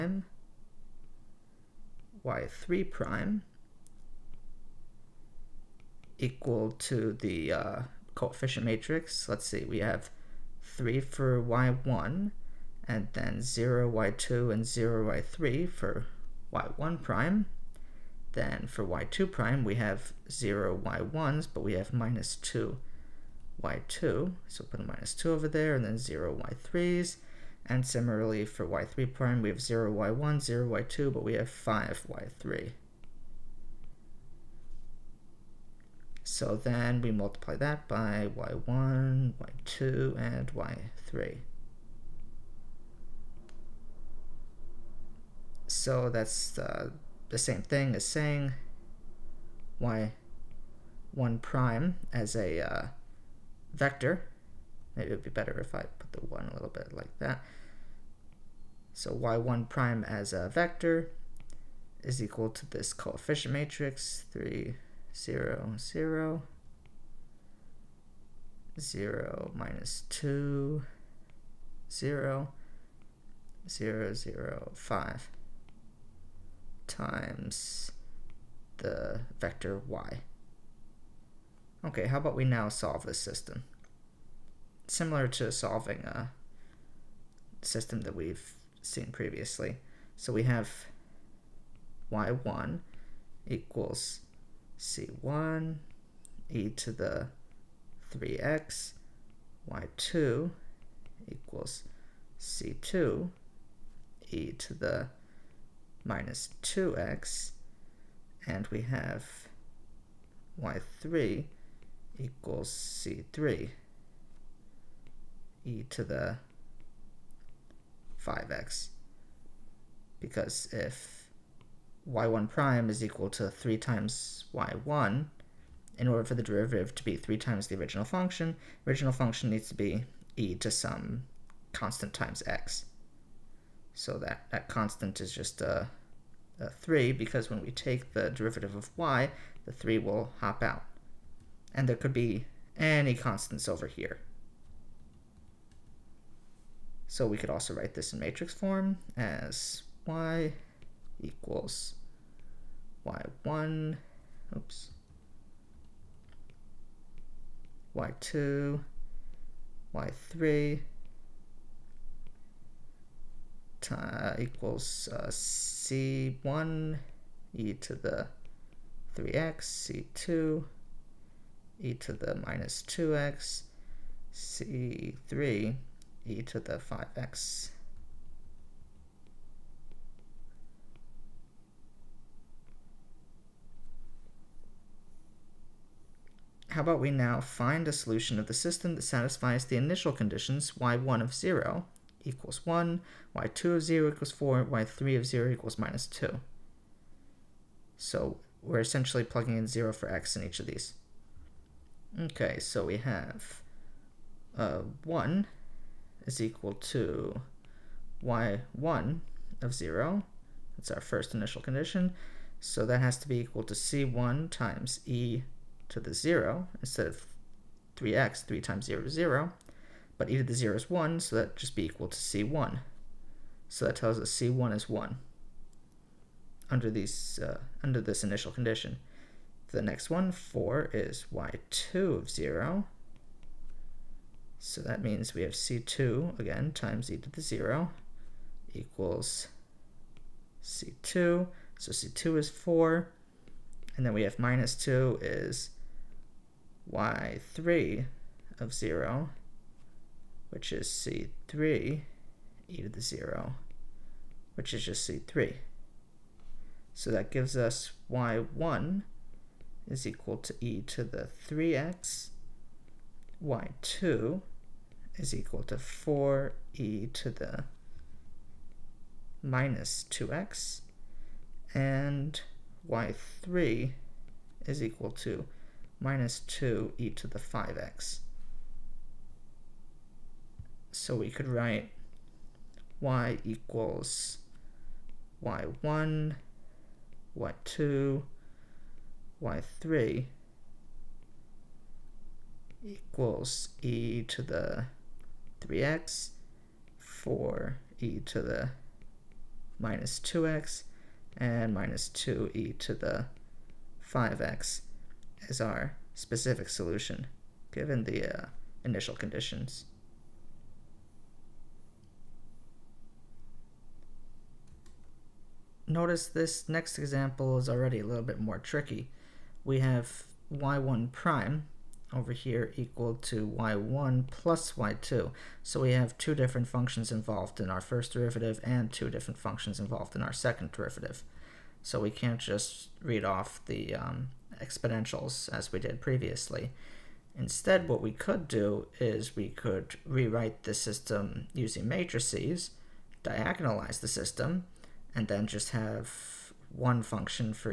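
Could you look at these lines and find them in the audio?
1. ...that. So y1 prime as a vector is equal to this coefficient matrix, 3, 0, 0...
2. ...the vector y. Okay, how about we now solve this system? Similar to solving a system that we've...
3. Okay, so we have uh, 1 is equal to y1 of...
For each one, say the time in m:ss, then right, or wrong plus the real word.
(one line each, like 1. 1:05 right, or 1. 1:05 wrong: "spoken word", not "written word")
1. 0:57 right
2. 1:18 right
3. 3:22 right.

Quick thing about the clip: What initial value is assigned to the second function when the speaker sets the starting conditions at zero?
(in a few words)
4.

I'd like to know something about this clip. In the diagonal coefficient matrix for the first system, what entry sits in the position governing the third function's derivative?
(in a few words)
5.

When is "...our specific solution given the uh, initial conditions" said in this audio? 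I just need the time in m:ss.
5:05.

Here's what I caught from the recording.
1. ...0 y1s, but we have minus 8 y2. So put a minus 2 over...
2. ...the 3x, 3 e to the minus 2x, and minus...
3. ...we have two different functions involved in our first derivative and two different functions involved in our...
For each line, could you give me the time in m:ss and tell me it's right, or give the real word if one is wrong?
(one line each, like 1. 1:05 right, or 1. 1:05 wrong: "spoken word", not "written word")
1. 0:20 wrong: "2", not "8"
2. 4:54 wrong: "4", not "3"
3. 5:25 right.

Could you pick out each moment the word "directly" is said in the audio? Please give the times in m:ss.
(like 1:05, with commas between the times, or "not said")
not said.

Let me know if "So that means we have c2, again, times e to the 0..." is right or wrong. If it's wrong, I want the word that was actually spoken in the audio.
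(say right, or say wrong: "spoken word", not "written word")
right.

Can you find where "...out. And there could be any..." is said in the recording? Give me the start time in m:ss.
2:20.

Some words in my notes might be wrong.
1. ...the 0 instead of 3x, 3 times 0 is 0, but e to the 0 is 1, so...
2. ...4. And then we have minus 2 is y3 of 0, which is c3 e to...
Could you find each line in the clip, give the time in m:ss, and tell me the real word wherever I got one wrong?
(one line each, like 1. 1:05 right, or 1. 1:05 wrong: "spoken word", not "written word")
1. 3:35 right
2. 4:02 right.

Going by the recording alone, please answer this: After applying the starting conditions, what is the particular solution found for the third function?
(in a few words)
-2e^(5x).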